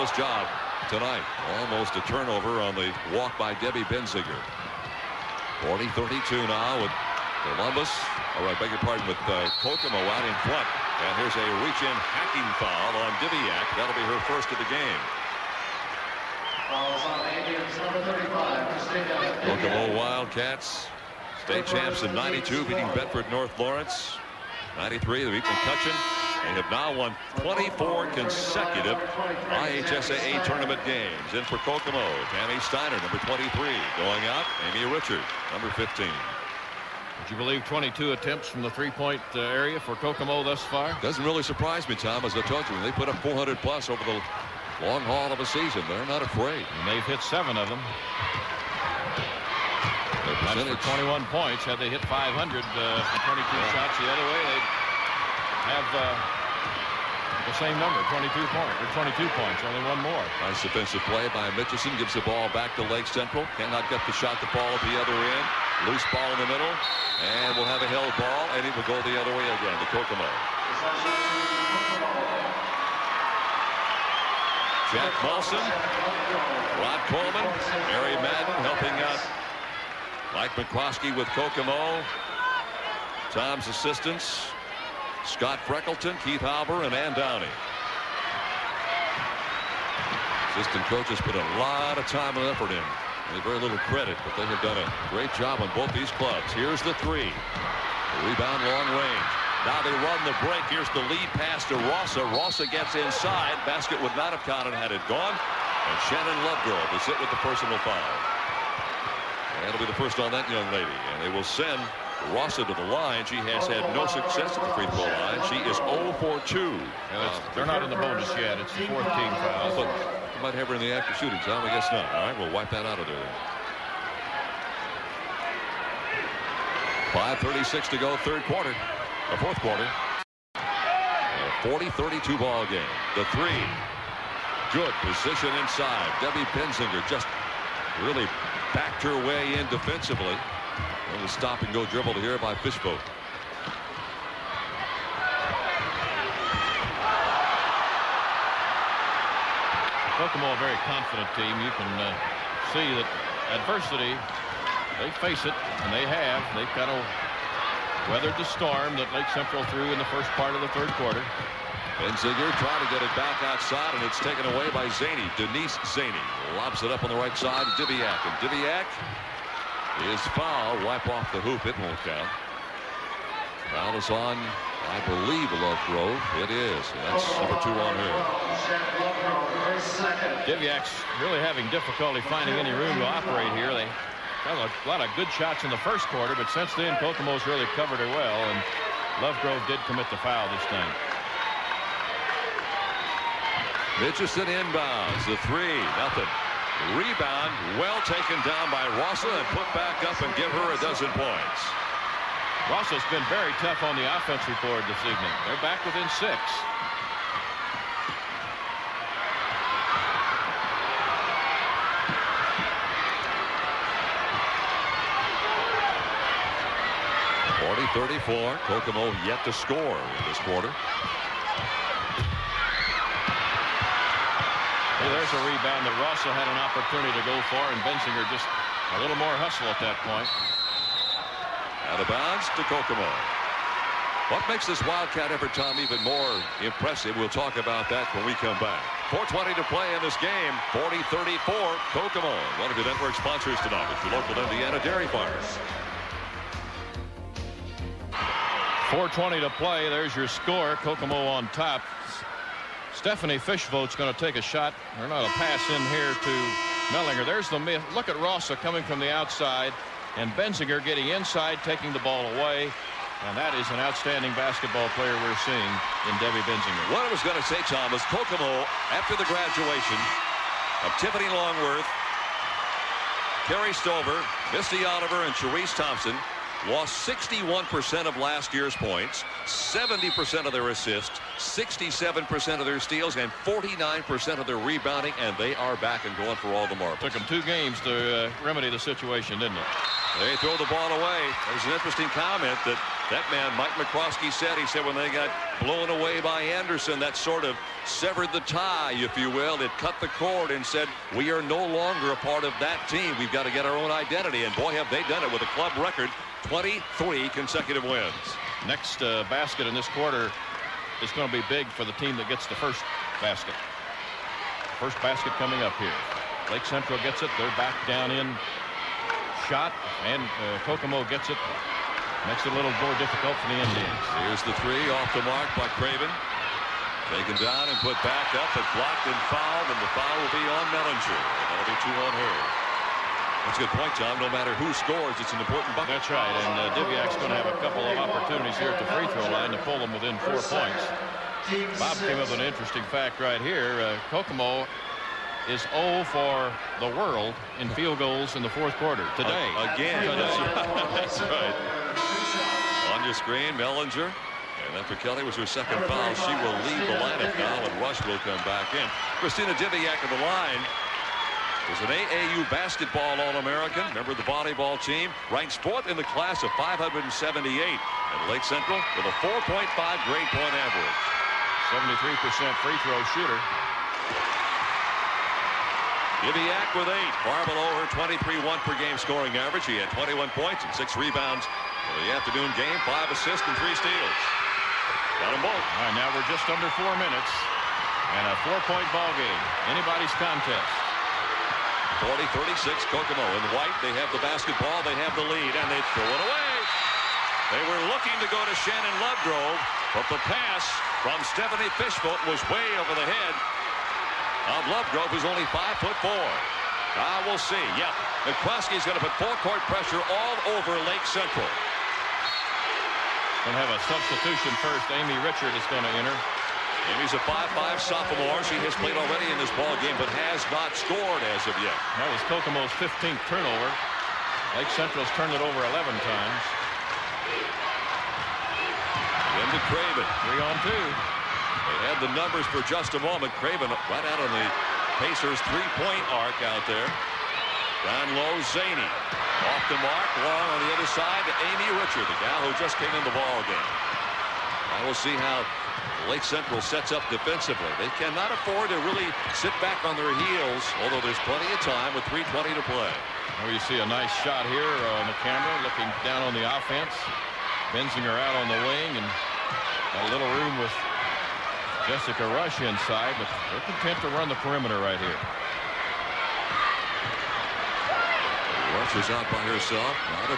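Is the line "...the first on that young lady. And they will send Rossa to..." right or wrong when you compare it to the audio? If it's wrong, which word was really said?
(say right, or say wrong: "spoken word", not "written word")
right.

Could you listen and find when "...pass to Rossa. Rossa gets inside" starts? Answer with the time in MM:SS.
01:41.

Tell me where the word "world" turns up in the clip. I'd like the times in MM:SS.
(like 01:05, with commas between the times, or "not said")
05:46.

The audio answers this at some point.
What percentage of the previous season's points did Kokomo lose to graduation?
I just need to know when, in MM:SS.
04:37.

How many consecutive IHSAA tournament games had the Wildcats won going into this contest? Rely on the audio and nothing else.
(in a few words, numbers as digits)
24.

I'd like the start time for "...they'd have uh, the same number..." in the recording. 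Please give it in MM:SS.
00:54.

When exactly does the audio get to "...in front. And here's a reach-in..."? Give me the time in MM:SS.
00:10.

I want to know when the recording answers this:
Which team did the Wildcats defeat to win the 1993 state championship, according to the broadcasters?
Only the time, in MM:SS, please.
00:25.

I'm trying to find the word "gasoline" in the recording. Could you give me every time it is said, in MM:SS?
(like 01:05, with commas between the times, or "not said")
not said.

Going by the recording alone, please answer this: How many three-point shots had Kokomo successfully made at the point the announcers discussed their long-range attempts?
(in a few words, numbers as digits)
seven.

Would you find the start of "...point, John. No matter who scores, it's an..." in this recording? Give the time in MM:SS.
05:33.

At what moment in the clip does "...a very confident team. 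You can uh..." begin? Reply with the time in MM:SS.
02:30.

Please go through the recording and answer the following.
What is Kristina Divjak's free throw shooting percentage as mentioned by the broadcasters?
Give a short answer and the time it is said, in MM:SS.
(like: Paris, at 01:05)
73%, at 06:11.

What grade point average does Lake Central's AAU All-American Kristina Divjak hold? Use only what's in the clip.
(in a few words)
4.5.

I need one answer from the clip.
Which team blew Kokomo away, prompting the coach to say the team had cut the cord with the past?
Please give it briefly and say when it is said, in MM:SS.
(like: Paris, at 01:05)
Anderson, at 04:56.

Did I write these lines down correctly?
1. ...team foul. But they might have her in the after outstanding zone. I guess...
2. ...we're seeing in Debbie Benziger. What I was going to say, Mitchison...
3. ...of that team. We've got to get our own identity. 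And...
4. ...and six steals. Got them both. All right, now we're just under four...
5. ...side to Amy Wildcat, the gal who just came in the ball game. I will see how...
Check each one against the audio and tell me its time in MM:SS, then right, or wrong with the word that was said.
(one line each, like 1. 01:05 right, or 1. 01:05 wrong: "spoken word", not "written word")
1. 01:59 wrong: "shooting", not "outstanding"
2. 04:25 wrong: "Tom", not "Mitchison"
3. 05:02 right
4. 06:23 wrong: "three", not "six"
5. 07:20 wrong: "Richard", not "Wildcat".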